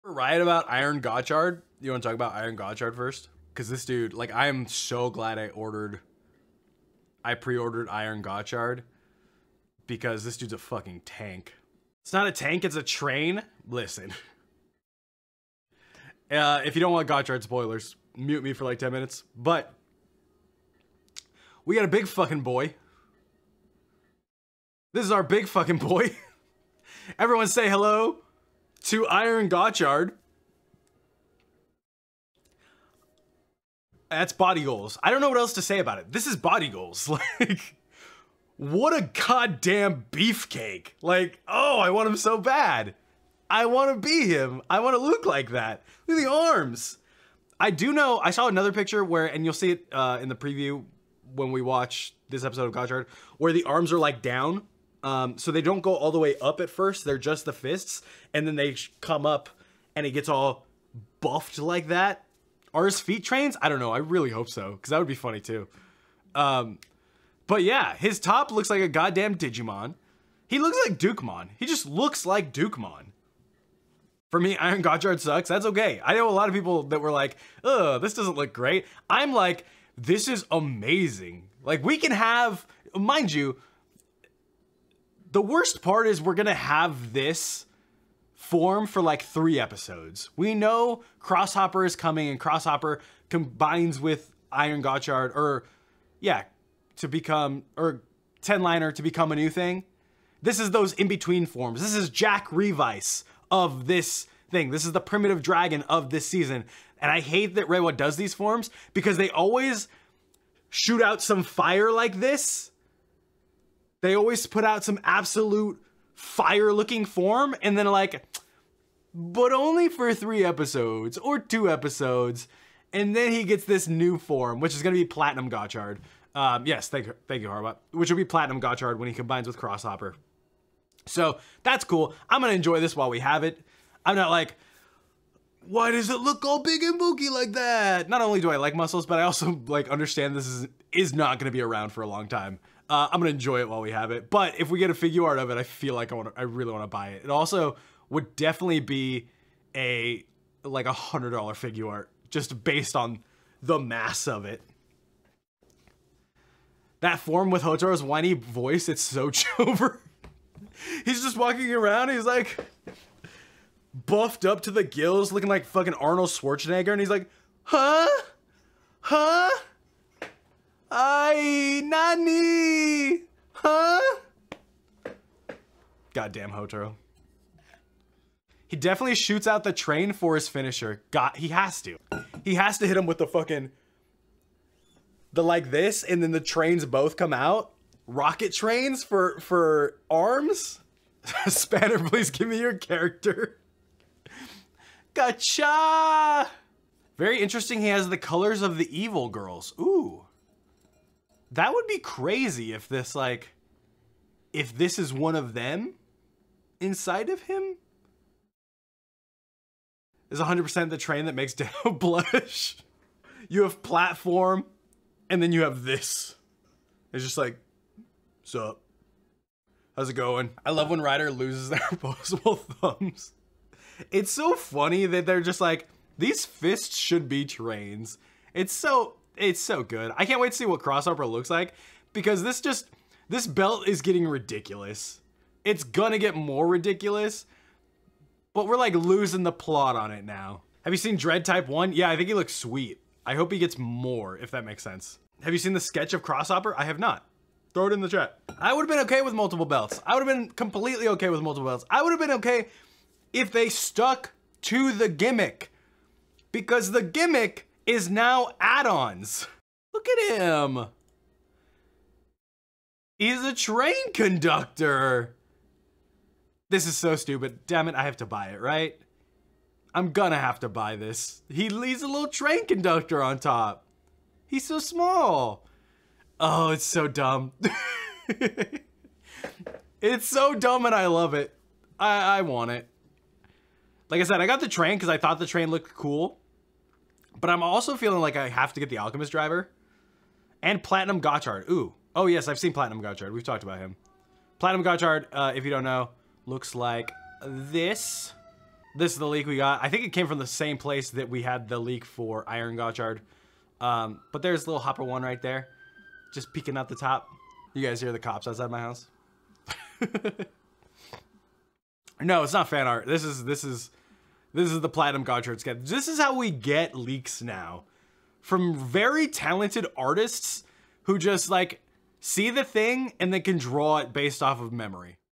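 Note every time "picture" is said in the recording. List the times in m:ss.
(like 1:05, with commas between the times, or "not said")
0:48.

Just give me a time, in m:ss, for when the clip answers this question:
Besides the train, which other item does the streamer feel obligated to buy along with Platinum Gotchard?
4:48.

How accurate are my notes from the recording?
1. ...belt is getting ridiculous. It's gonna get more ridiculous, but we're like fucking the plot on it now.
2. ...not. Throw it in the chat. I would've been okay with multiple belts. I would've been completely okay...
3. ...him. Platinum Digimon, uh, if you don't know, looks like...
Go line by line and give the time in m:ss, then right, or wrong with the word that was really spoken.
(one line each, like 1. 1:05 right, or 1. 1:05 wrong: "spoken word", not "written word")
1. 3:53 wrong: "losing", not "fucking"
2. 4:06 right
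3. 4:53 wrong: "Gotchard", not "Digimon".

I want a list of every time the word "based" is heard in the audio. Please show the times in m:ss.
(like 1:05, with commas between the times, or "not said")
2:32, 5:24.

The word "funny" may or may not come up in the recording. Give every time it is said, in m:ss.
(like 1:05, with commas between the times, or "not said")
1:05, 3:44.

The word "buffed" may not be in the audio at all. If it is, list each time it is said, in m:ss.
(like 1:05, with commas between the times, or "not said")
1:01, 2:44.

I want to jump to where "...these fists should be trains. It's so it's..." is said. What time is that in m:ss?
3:46.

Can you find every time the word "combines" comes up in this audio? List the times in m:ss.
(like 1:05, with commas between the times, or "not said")
1:33, 2:09.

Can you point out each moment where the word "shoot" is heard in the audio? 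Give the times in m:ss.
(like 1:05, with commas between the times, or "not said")
1:50, 2:59.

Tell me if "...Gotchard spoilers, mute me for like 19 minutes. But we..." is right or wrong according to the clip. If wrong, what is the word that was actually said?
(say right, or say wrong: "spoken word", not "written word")
wrong: "10", not "19".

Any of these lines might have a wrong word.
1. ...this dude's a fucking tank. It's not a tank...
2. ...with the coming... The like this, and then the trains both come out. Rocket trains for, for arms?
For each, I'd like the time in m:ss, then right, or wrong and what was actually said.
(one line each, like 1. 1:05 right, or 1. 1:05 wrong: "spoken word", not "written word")
1. 0:10 right
2. 3:03 wrong: "fucking", not "coming".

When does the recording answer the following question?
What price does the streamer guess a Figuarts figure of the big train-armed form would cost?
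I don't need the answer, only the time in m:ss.
2:30.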